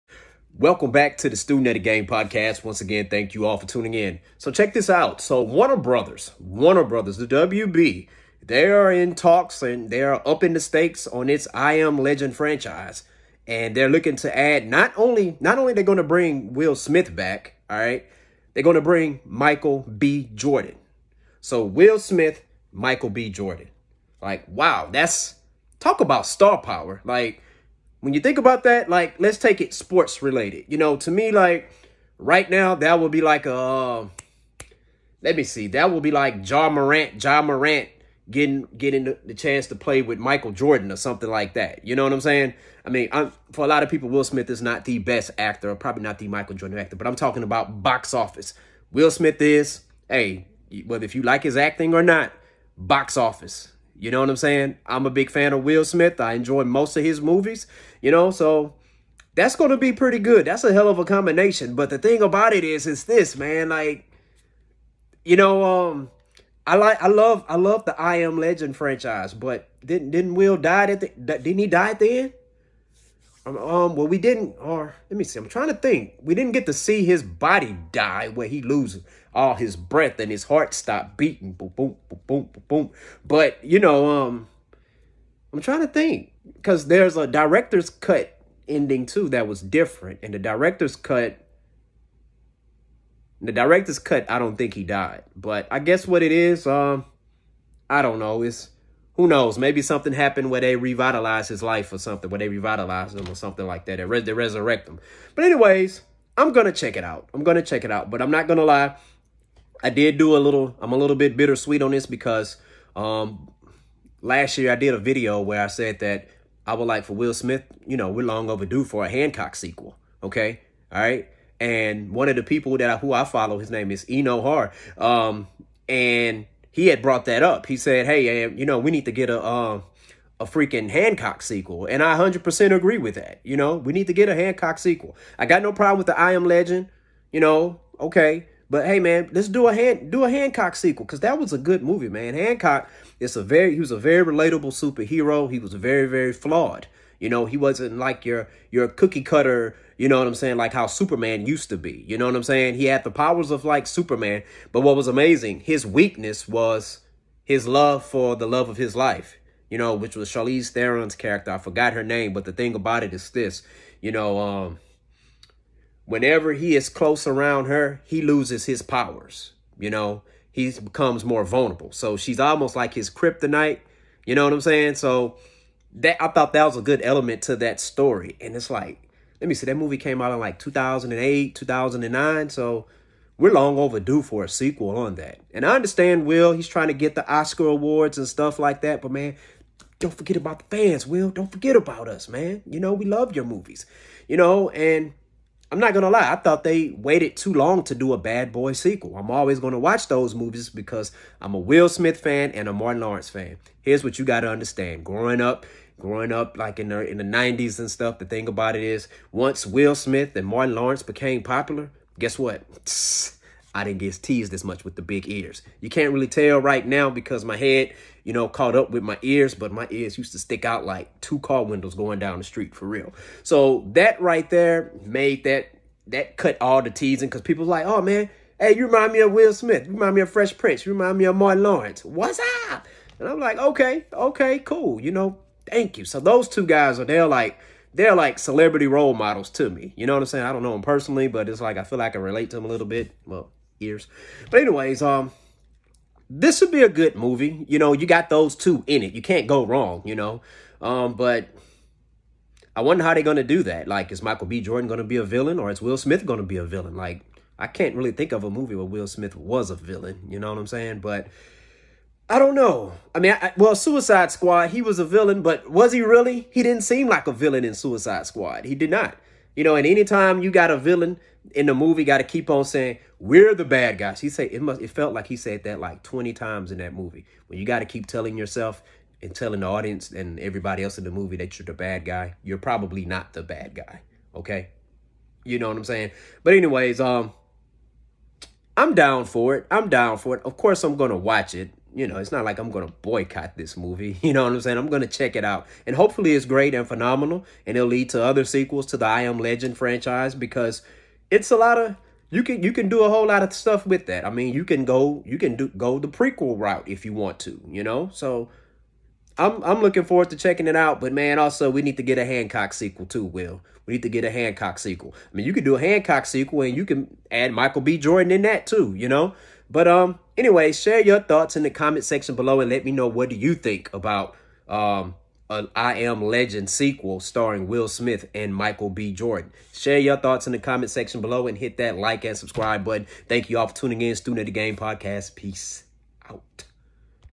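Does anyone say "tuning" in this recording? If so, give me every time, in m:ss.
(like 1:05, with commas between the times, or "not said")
0:03, 5:33.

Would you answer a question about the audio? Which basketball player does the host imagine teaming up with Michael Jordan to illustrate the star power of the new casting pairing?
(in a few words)
Ja Morant.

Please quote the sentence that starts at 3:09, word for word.
But man, don't forget about the fans, Will.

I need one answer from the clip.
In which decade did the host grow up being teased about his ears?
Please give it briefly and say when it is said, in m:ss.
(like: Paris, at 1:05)
1990s, at 3:27.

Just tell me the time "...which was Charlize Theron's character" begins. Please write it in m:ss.
2:39.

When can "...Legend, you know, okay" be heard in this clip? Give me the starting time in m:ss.
2:16.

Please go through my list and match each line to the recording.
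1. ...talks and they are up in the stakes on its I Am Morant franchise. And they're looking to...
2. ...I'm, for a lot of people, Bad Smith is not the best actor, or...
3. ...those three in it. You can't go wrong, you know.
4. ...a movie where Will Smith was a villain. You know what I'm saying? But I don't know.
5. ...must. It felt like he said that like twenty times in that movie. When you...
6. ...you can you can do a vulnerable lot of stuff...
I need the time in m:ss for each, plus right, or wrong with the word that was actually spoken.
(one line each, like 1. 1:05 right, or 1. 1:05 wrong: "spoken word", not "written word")
1. 0:09 wrong: "Legend", not "Morant"
2. 0:43 wrong: "Will", not "Bad"
3. 4:08 wrong: "two", not "three"
4. 4:18 right
5. 4:34 right
6. 5:02 wrong: "whole", not "vulnerable".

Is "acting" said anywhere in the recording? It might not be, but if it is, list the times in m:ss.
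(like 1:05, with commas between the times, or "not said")
0:51.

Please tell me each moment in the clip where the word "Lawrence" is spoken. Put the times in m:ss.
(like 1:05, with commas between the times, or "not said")
3:23, 3:30, 3:51.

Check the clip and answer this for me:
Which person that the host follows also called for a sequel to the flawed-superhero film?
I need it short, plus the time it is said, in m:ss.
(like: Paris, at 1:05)
Eno Har, at 2:04.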